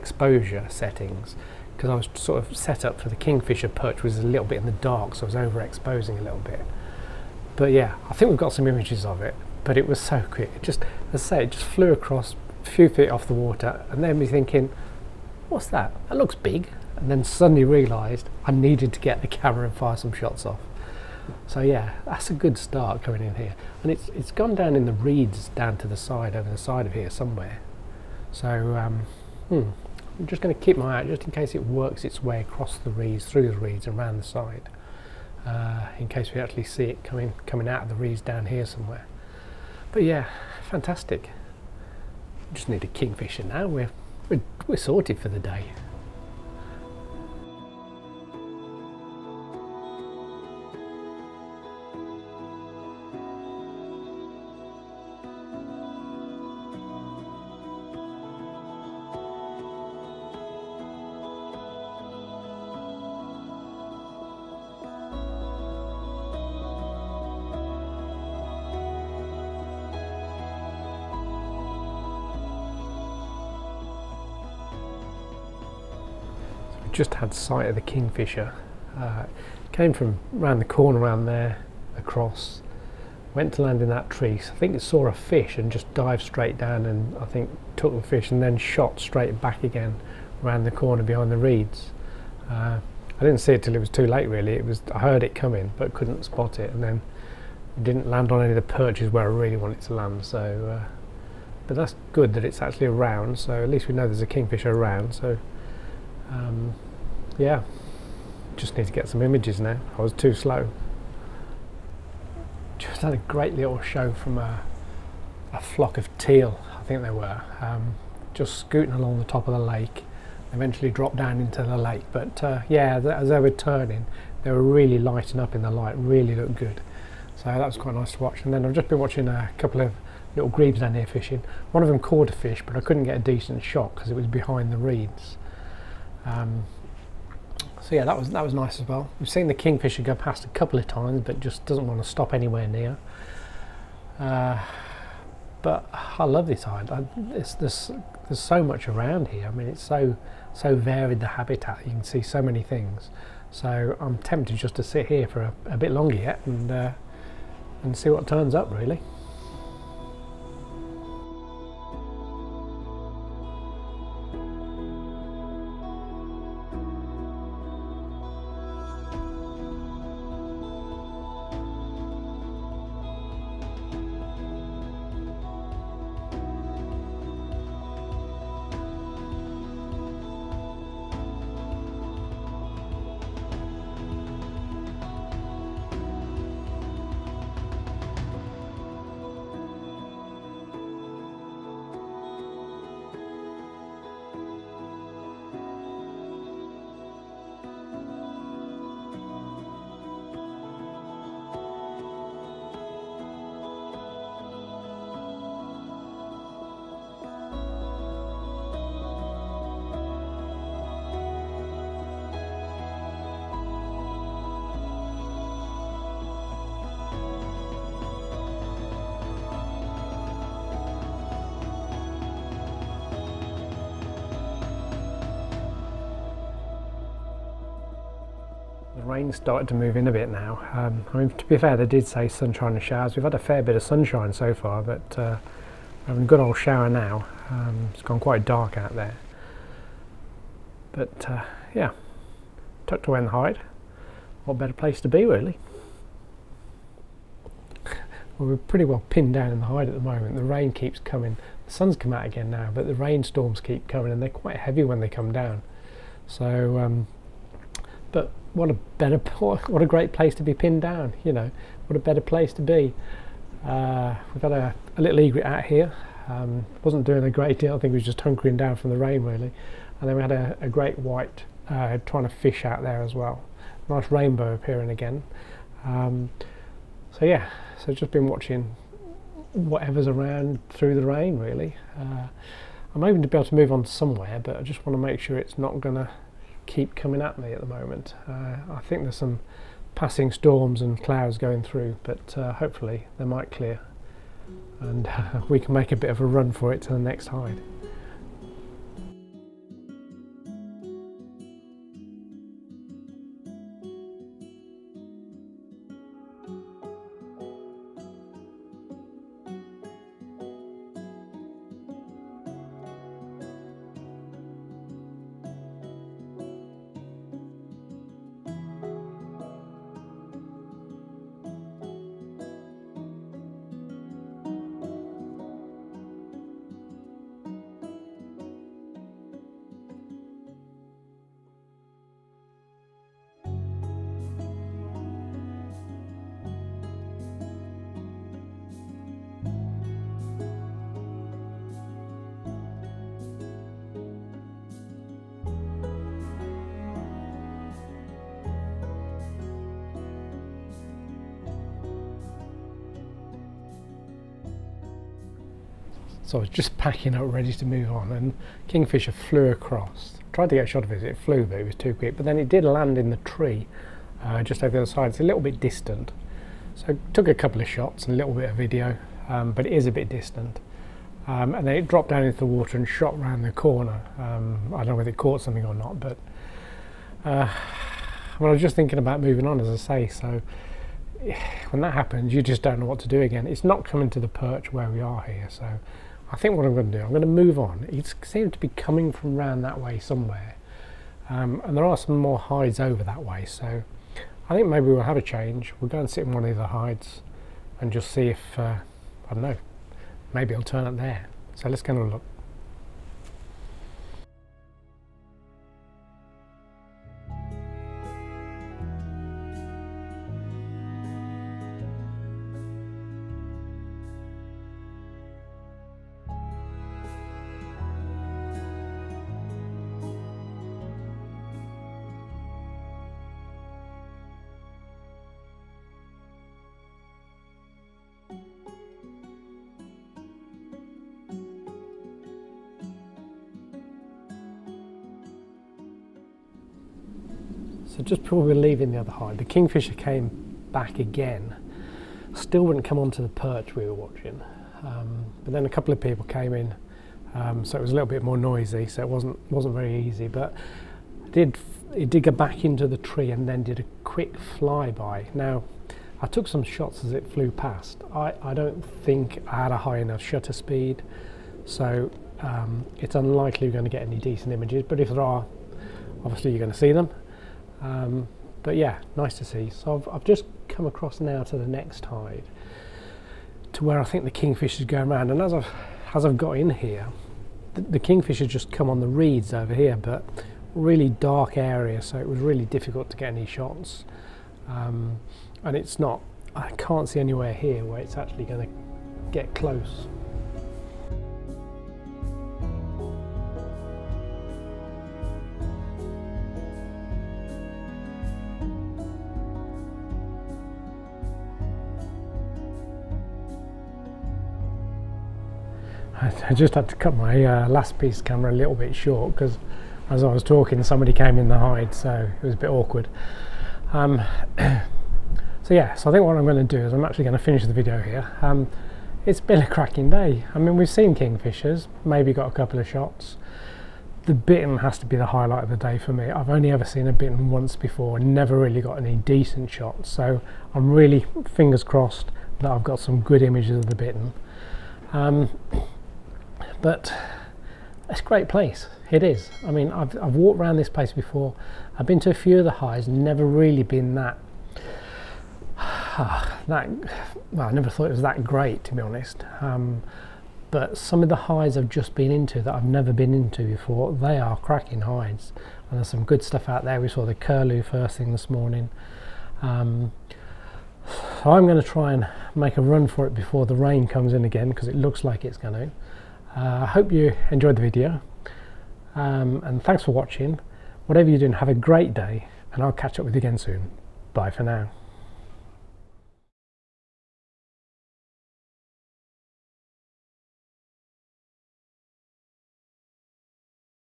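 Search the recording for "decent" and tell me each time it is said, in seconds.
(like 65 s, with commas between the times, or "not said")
133 s, 464 s, 529 s.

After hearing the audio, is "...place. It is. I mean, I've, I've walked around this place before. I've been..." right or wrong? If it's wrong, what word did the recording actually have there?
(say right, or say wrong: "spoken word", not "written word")
right.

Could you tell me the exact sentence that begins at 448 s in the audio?
So it wasn't wasn't very easy.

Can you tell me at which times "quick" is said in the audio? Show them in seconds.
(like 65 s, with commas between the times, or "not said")
10 s, 361 s, 454 s.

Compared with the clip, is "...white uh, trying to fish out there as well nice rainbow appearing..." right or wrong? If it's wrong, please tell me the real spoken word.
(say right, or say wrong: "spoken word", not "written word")
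right.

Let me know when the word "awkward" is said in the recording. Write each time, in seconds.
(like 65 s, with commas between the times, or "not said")
512 s.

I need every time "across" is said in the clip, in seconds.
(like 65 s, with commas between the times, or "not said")
11 s, 32 s, 81 s, 359 s, 470 s.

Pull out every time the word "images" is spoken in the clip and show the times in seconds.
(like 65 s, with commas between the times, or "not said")
8 s, 109 s, 464 s, 533 s.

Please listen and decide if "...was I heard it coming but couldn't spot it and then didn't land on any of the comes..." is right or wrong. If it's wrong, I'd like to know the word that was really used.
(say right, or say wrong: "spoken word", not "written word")
wrong: "perches", not "comes".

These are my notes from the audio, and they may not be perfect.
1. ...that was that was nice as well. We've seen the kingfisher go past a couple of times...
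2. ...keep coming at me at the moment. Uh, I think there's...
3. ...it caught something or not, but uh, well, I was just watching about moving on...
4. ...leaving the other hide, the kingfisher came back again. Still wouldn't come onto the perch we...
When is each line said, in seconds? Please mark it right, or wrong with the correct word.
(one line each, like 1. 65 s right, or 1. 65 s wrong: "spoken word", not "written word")
1. 138 s right
2. 286 s right
3. 375 s wrong: "thinking", not "watching"
4. 438 s right.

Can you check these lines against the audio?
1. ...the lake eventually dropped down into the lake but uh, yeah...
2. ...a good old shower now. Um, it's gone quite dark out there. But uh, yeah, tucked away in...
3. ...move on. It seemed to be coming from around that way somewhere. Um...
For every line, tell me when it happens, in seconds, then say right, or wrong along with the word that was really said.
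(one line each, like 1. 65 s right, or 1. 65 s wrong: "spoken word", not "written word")
1. 119 s right
2. 236 s right
3. 387 s right.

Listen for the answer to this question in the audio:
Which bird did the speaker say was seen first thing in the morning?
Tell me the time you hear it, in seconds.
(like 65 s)
557 s.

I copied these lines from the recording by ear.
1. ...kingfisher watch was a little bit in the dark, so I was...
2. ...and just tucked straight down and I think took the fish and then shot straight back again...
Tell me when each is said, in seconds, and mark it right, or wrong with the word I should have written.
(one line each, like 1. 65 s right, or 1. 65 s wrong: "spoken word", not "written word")
1. 3 s wrong: "perch", not "watch"
2. 85 s wrong: "dived", not "tucked".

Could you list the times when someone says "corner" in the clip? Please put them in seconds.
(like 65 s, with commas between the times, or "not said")
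80 s, 90 s, 373 s.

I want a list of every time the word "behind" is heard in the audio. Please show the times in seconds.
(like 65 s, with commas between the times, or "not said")
91 s, 134 s.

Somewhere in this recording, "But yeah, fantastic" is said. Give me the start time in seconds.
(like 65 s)
39 s.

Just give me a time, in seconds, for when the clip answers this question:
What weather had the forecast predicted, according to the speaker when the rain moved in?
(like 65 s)
232 s.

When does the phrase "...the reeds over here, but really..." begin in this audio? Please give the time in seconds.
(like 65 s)
478 s.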